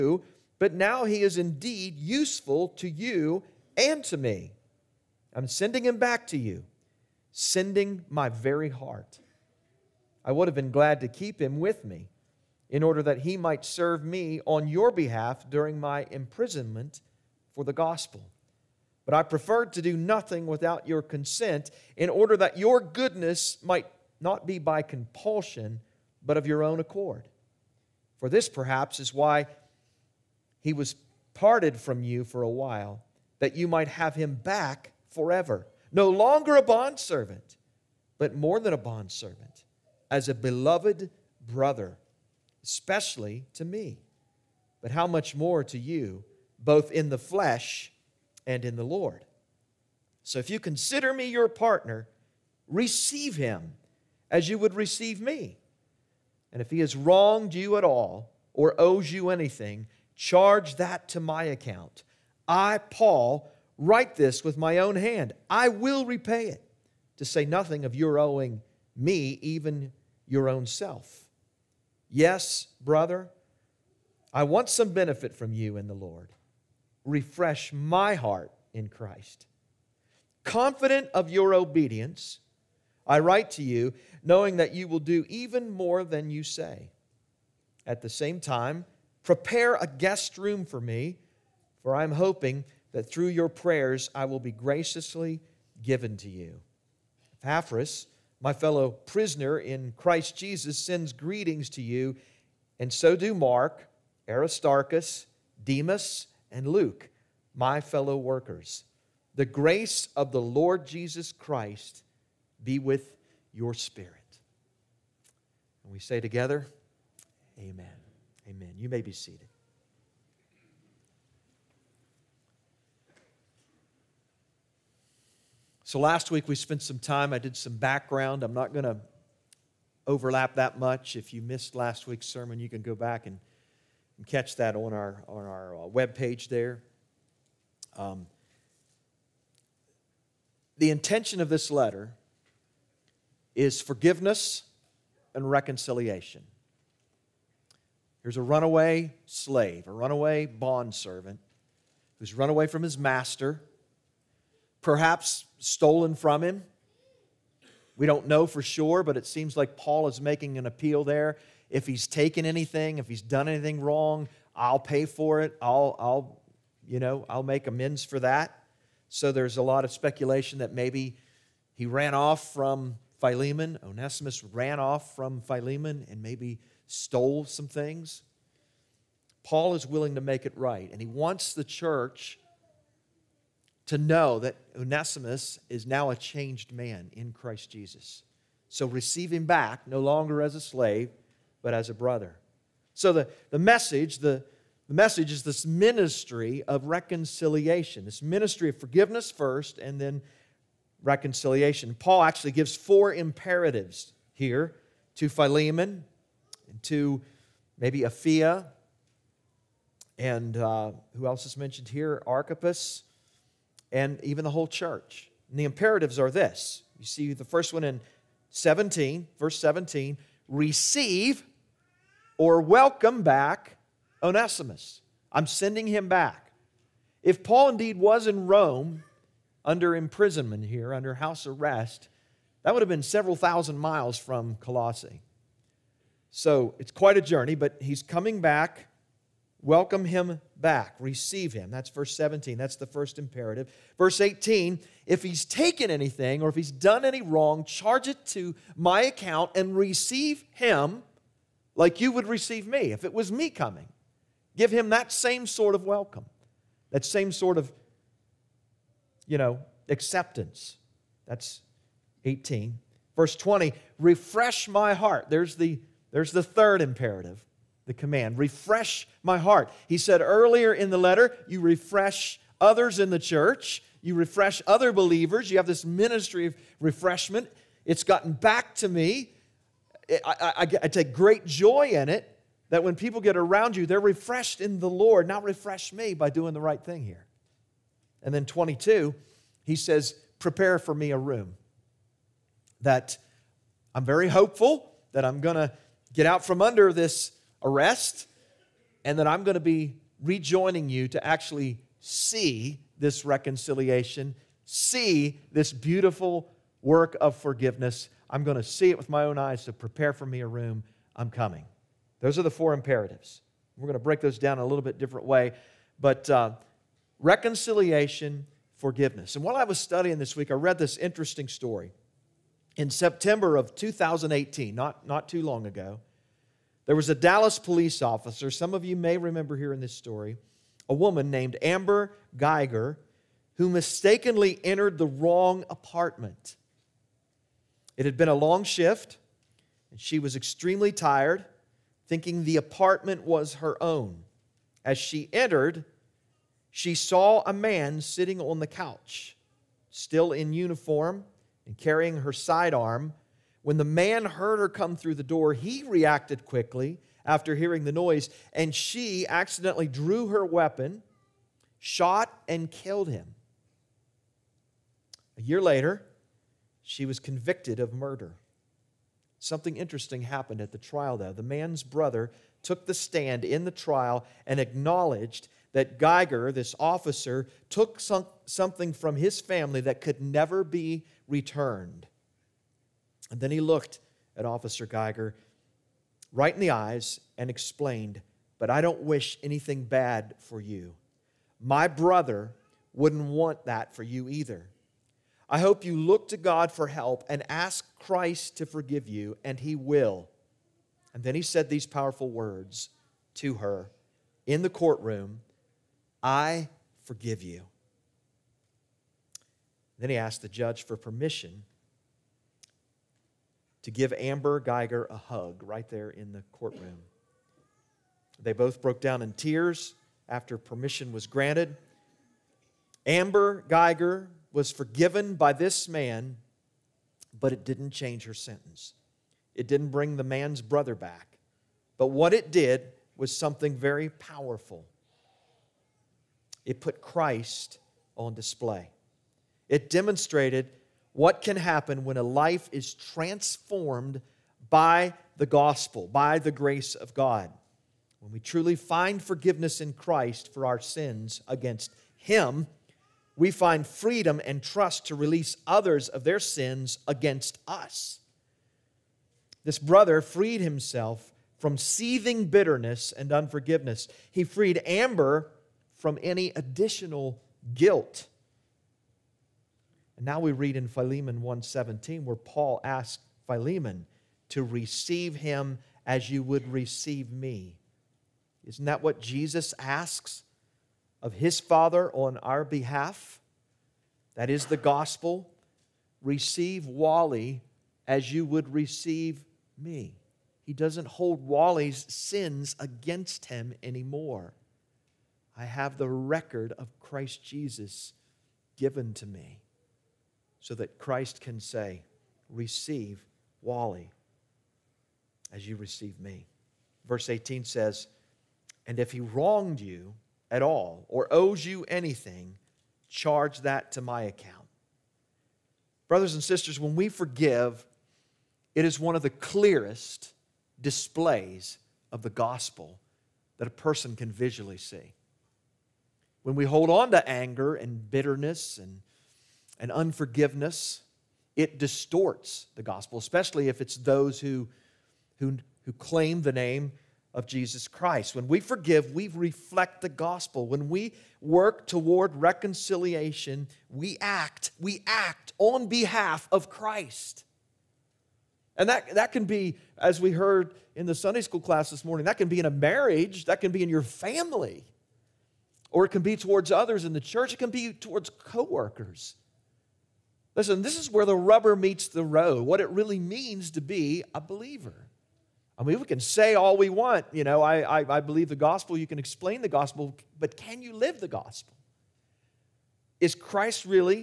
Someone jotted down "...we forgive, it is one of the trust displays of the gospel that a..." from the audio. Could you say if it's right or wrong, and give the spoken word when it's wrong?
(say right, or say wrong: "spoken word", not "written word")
wrong: "clearest", not "trust".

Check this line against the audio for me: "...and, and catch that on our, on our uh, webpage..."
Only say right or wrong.
right.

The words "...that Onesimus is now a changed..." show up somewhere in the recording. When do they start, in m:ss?
3:04.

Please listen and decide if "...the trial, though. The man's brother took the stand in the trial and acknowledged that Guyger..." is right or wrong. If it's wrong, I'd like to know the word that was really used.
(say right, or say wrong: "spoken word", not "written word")
right.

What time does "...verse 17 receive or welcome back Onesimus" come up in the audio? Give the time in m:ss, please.
3:39.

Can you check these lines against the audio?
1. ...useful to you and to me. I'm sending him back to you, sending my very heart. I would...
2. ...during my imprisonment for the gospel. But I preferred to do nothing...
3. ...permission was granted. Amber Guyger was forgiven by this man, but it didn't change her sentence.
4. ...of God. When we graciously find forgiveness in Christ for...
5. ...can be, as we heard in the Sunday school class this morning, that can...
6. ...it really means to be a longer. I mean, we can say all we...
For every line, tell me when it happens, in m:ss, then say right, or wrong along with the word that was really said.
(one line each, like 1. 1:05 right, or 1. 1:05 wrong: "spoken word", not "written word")
1. 0:01 right
2. 0:15 right
3. 7:00 right
4. 7:26 wrong: "truly", not "graciously"
5. 9:09 right
6. 9:22 wrong: "believer", not "longer".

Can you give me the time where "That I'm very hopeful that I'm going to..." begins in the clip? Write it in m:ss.
4:52.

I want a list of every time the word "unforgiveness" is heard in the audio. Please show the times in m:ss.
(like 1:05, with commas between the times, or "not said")
7:43, 8:49.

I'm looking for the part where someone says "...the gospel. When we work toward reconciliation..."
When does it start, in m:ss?
9:00.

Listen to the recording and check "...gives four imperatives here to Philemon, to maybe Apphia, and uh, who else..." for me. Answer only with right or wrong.
right.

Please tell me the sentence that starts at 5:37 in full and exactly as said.
It had been a long shift, and she was extremely tired, thinking the apartment was her own.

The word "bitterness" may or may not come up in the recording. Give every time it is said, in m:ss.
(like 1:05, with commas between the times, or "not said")
7:42, 8:48.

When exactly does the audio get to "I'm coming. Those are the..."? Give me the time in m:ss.
5:11.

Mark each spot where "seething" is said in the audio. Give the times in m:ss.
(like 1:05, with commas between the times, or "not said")
7:41.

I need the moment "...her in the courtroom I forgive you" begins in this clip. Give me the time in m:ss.
6:43.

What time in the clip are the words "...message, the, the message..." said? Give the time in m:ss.
3:13.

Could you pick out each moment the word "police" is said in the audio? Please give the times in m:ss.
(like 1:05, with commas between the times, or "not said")
5:27.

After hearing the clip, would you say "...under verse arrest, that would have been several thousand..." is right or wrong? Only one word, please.
wrong.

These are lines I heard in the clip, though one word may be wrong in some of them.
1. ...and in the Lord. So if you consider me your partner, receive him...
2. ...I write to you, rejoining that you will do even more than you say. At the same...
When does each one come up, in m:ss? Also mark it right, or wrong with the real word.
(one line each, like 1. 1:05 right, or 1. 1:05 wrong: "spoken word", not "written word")
1. 0:48 right
2. 1:23 wrong: "knowing", not "rejoining".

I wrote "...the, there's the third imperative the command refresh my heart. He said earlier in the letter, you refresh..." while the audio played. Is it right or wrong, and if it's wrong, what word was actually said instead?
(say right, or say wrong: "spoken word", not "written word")
right.